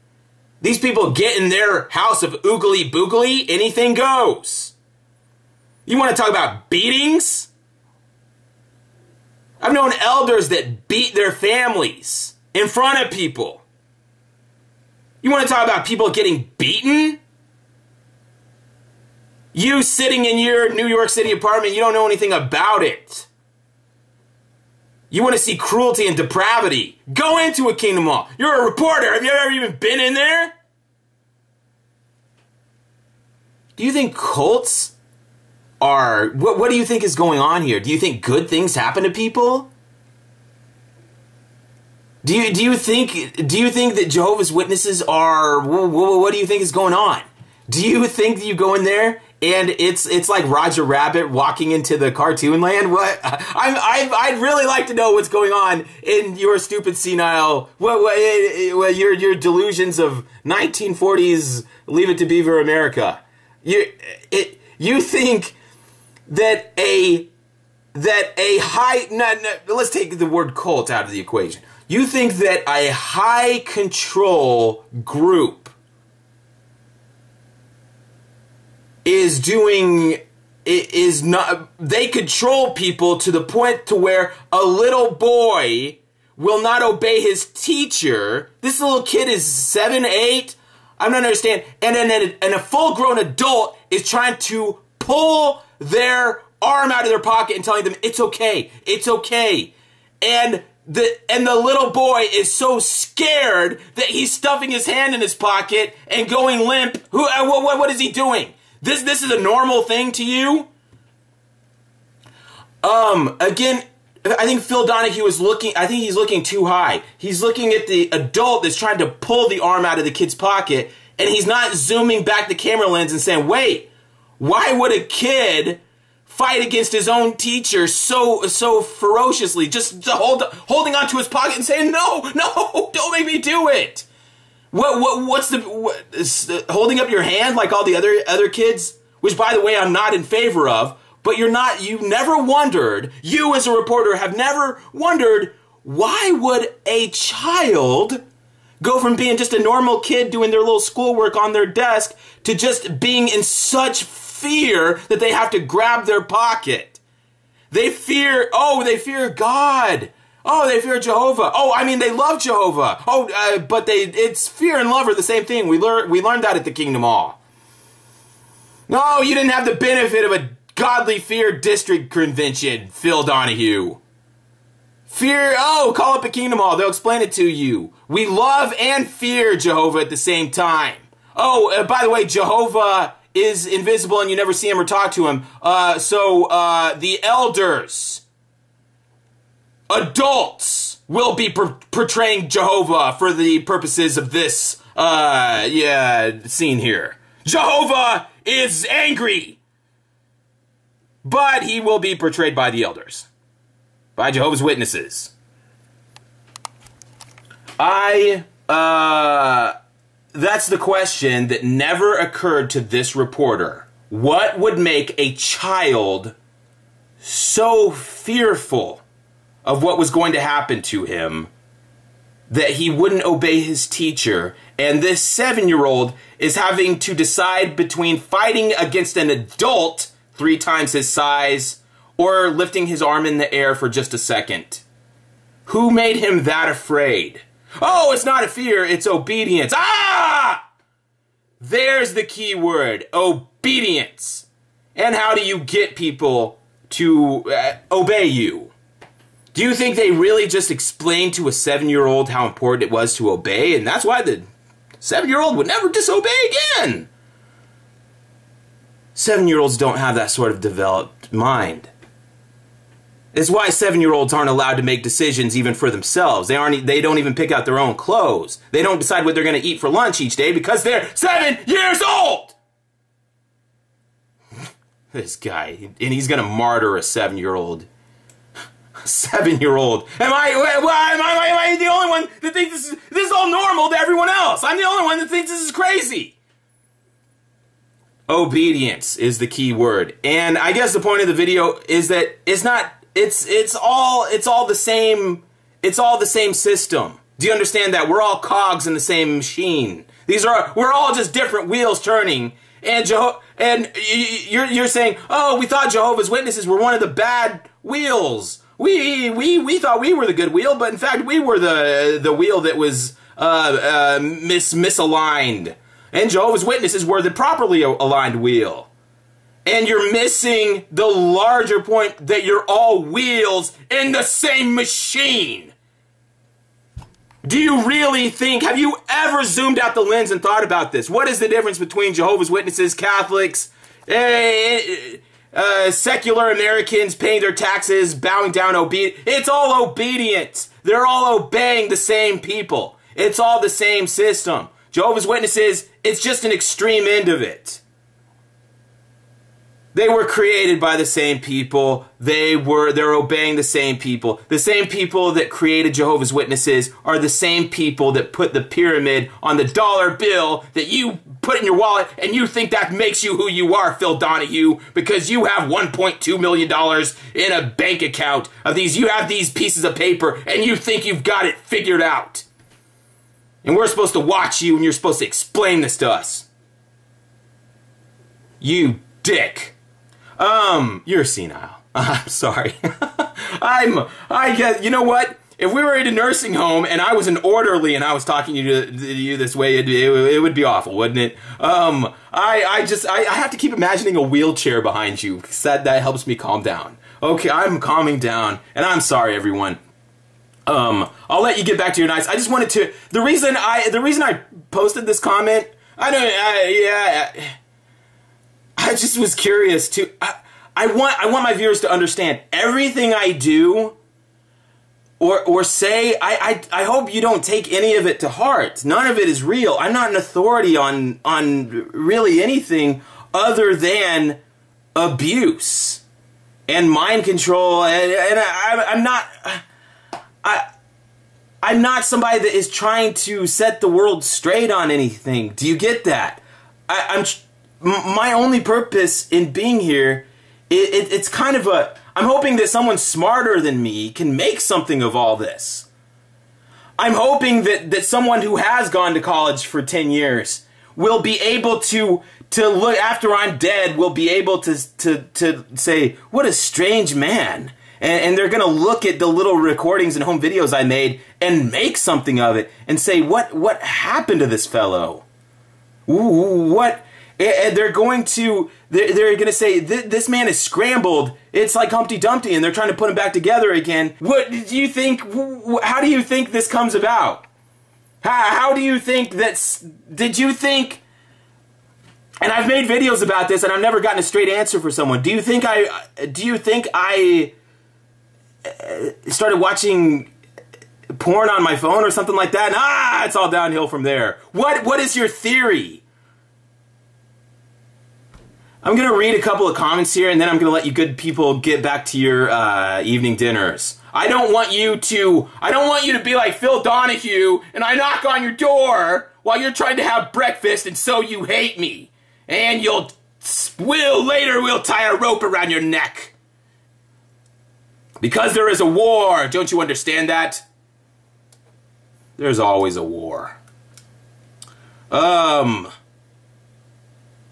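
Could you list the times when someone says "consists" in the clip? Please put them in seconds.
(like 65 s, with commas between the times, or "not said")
not said.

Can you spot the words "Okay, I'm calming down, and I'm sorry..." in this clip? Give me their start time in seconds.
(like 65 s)
397 s.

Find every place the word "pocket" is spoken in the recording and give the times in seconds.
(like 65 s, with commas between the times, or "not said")
97 s, 105 s, 120 s, 131 s, 156 s.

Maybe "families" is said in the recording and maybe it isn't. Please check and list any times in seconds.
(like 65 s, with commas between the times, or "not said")
11 s.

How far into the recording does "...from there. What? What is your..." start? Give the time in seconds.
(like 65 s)
493 s.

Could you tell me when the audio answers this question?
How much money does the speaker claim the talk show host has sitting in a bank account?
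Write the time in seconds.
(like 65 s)
365 s.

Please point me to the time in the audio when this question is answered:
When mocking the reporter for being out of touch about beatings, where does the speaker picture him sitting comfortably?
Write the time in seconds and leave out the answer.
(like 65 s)
20 s.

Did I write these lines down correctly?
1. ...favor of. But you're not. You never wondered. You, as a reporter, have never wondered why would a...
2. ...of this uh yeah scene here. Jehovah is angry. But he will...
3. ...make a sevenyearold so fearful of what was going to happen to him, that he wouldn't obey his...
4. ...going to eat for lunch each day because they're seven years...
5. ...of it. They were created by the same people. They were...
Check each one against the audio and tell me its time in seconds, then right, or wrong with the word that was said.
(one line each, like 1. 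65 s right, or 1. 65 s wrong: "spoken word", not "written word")
1. 140 s right
2. 194 s right
3. 214 s wrong: "child", not "sevenyearold"
4. 269 s right
5. 347 s right.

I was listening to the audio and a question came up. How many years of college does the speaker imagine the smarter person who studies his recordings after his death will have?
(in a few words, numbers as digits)
10 years.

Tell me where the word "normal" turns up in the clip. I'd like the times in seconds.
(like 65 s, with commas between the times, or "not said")
109 s, 149 s, 283 s.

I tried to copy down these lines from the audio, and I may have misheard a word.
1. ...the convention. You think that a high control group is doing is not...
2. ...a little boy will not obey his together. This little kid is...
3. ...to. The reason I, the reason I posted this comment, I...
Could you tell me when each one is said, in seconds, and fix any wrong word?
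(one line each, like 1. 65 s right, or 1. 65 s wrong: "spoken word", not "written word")
1. 71 s wrong: "equation", not "convention"
2. 84 s wrong: "teacher", not "together"
3. 402 s right.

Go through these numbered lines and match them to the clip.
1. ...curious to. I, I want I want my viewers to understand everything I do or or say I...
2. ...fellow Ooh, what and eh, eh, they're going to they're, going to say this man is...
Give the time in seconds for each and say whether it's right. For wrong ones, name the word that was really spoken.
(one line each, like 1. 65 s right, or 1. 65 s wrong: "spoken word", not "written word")
1. 409 s right
2. 464 s right.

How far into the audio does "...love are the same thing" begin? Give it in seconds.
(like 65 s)
164 s.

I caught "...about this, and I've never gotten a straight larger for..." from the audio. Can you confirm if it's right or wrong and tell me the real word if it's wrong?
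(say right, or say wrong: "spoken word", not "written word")
wrong: "answer", not "larger".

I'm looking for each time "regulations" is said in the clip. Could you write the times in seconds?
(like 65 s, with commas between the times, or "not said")
not said.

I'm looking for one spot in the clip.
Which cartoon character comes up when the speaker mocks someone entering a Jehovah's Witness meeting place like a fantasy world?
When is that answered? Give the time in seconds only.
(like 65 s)
50 s.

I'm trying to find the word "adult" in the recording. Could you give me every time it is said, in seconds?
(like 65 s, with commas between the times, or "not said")
93 s, 118 s, 189 s, 229 s.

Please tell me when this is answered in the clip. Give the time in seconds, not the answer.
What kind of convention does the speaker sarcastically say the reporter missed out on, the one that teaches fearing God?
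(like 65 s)
170 s.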